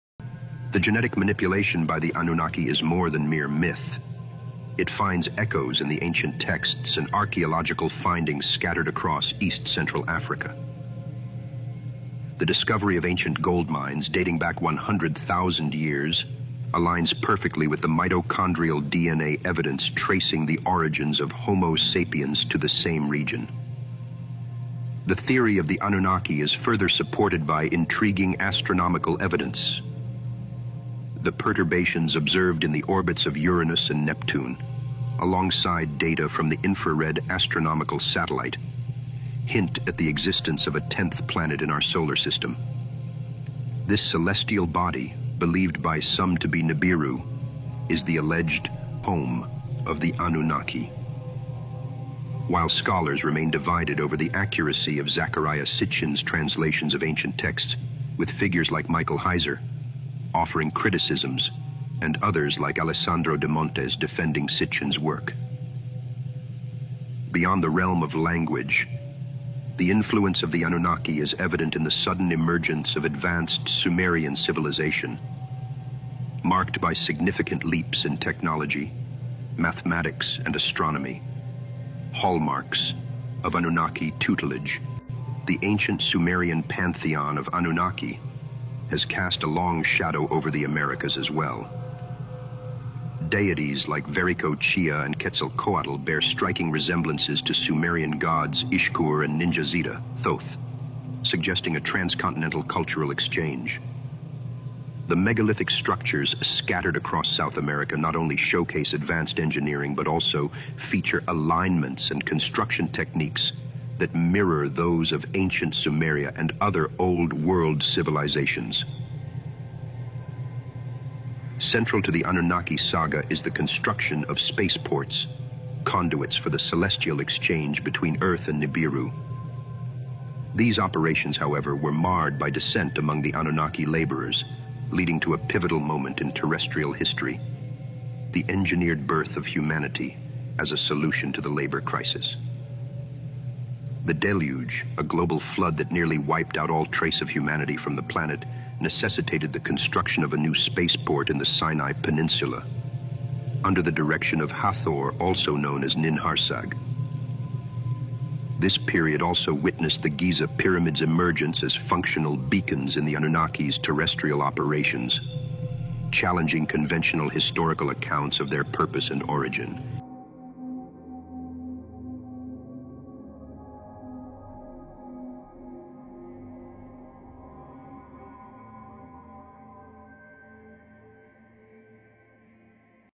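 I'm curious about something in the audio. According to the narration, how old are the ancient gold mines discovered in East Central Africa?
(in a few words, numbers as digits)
100,000 years.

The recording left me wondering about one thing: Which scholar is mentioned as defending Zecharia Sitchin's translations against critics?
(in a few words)
Alessandro Demontis.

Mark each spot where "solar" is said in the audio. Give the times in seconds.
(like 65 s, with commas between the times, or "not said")
41 s.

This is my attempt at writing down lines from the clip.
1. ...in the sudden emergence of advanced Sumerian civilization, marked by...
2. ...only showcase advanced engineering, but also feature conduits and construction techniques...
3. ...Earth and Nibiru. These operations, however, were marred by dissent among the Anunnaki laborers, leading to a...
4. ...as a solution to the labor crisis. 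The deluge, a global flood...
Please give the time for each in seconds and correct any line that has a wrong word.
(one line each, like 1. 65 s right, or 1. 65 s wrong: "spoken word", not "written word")
1. 71 s right
2. 108 s wrong: "alignments", not "conduits"
3. 128 s right
4. 140 s right.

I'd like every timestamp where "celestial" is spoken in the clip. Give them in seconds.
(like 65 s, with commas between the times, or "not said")
44 s, 126 s.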